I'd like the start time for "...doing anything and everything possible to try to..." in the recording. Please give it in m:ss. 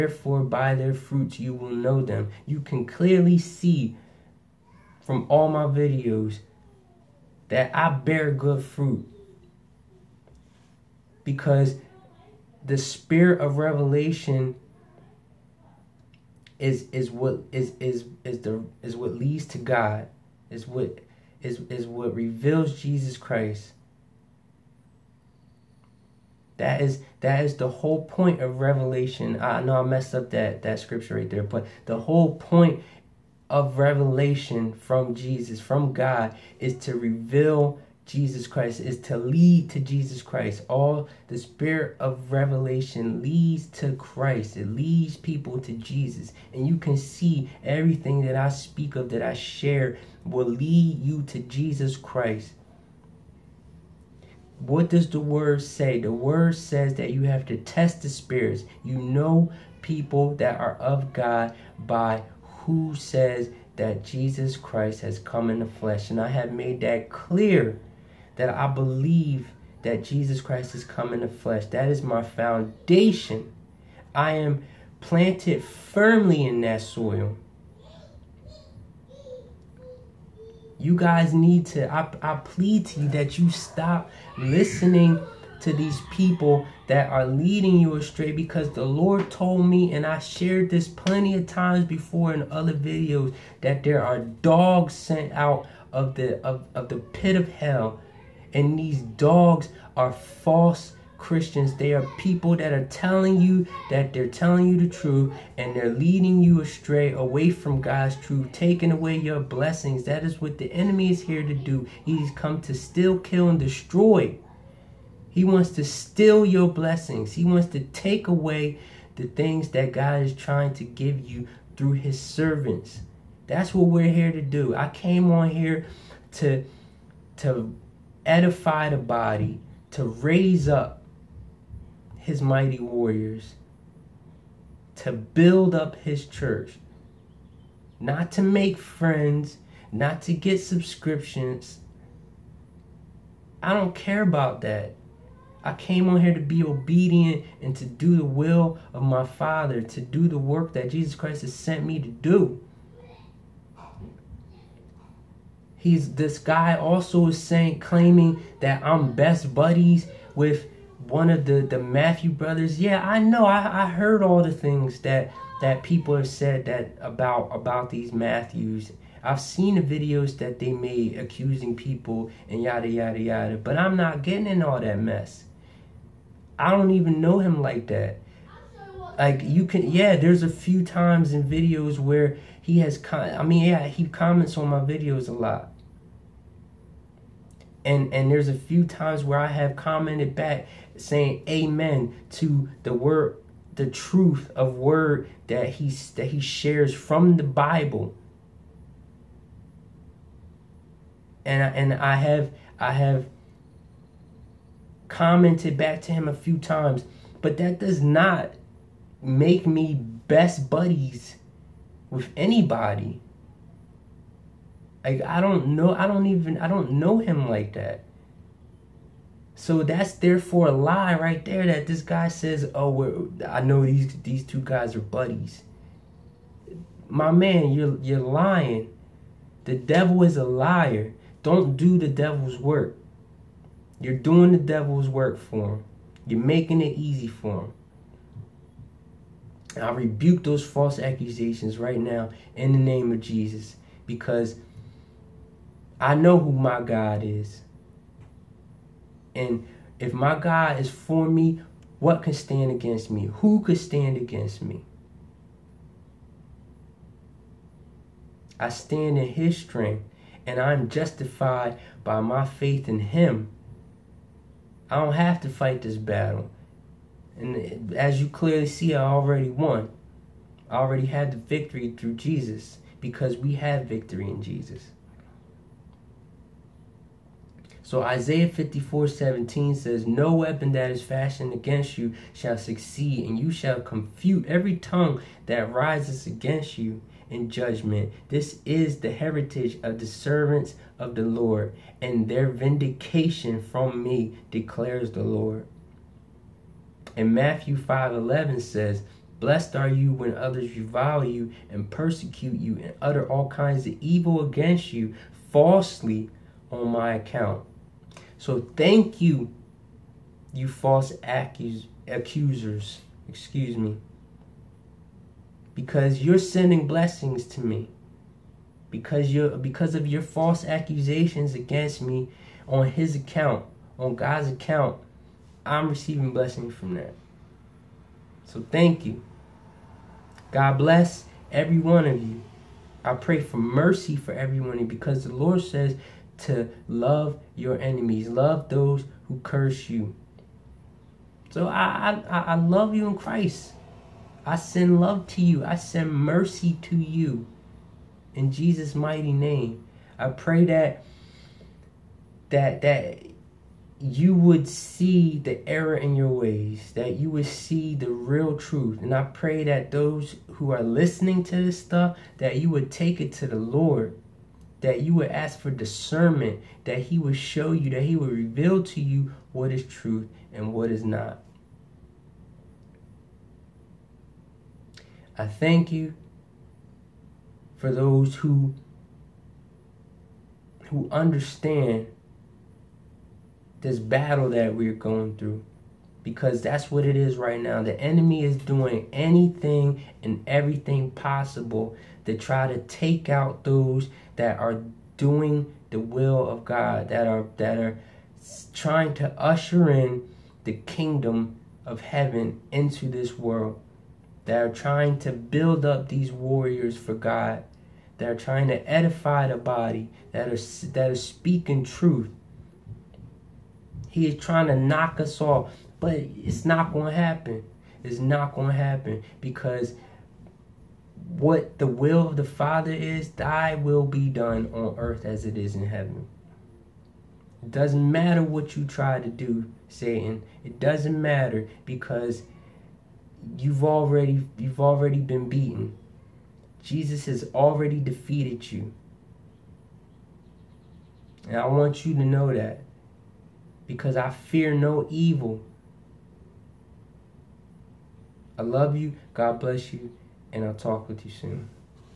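6:28.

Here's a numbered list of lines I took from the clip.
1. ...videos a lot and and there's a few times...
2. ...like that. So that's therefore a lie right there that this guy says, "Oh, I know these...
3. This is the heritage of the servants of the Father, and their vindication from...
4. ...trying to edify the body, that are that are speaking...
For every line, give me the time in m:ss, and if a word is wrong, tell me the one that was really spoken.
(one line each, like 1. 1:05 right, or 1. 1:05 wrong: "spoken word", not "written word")
1. 3:04 right
2. 3:37 right
3. 4:48 wrong: "Lord", not "Father"
4. 6:48 right.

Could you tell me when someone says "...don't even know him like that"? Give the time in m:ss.
2:56.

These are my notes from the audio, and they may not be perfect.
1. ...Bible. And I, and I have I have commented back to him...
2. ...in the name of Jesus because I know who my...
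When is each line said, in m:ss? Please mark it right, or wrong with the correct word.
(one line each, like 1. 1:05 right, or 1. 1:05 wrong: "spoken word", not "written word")
1. 3:17 right
2. 4:02 right.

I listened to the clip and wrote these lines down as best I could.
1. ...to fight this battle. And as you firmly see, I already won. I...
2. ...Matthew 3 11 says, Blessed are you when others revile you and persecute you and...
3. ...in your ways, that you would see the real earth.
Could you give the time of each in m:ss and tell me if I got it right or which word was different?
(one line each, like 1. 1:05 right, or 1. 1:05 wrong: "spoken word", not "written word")
1. 4:25 wrong: "clearly", not "firmly"
2. 4:57 wrong: "5", not "3"
3. 5:55 wrong: "truth", not "earth".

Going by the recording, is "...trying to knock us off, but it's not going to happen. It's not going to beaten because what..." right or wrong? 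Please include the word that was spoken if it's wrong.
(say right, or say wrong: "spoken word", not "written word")
wrong: "happen", not "beaten".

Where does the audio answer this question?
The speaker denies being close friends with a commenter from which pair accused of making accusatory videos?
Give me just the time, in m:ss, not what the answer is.
2:41.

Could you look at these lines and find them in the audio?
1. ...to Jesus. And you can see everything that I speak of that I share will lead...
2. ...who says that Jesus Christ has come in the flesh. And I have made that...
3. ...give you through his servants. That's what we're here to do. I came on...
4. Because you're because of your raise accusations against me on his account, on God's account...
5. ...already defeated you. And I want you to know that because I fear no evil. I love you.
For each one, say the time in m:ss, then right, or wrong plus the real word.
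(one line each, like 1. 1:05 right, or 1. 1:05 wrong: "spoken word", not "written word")
1. 0:45 right
2. 1:02 right
3. 2:00 right
4. 5:18 wrong: "false", not "raise"
5. 7:17 right.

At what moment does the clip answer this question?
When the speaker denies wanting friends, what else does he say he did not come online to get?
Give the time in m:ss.
2:20.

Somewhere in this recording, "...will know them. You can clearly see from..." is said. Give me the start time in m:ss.
0:01.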